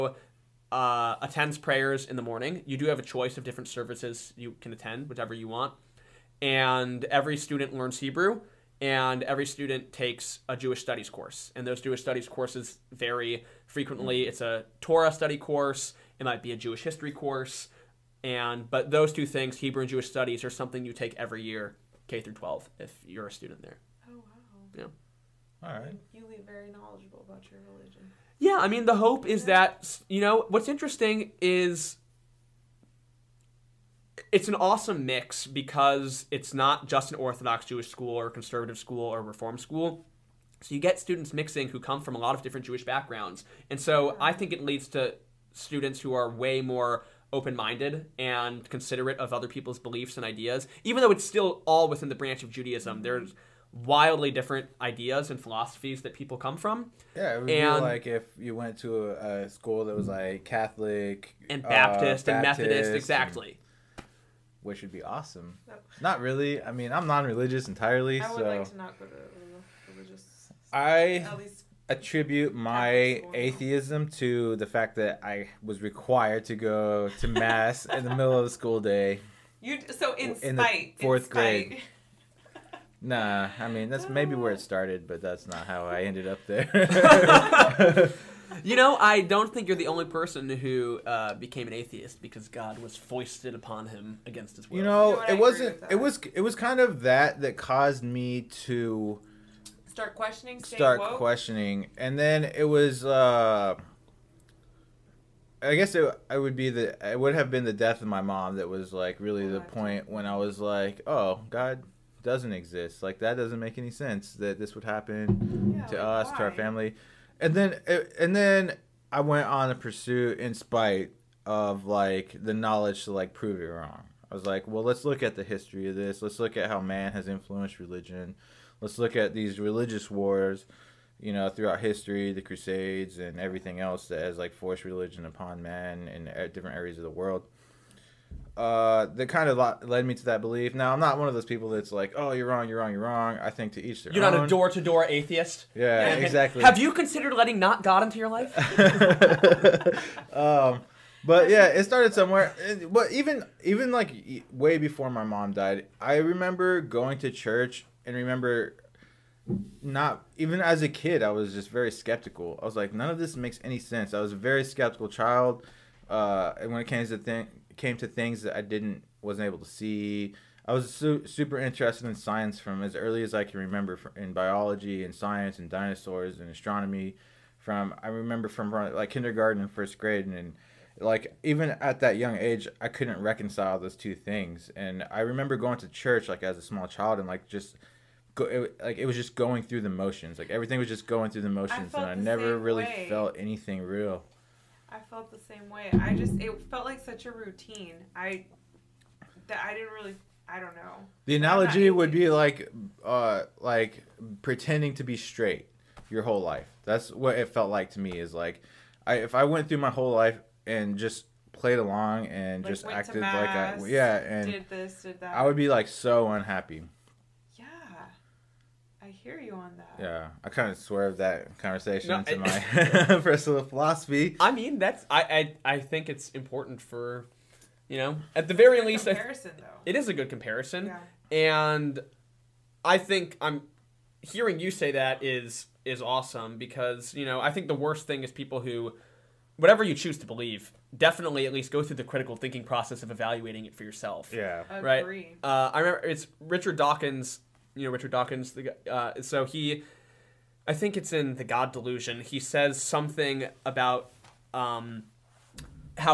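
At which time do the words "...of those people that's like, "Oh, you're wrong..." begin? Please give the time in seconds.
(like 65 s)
141 s.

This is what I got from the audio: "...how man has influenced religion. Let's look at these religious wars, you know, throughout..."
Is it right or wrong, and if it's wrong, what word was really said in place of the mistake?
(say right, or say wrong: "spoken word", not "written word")
right.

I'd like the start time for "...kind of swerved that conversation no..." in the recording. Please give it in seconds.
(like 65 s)
220 s.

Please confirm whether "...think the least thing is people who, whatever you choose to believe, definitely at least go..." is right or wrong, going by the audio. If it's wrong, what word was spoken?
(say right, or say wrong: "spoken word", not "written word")
wrong: "worst", not "least".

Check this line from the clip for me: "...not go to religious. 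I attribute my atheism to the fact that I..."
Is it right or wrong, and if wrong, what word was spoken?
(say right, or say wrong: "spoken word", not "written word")
right.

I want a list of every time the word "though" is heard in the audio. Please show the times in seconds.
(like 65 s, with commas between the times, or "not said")
51 s, 229 s.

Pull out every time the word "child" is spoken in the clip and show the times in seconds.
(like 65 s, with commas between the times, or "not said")
165 s, 186 s.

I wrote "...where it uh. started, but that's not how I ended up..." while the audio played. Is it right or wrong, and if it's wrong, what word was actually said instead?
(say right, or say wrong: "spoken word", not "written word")
right.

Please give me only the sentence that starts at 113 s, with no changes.
Like that doesn't make any sense that this would happen yeah, to like us, why?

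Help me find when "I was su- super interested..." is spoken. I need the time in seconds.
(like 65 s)
170 s.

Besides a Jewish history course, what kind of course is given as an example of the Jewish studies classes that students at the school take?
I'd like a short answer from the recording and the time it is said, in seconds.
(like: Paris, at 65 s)
Torah study, at 14 s.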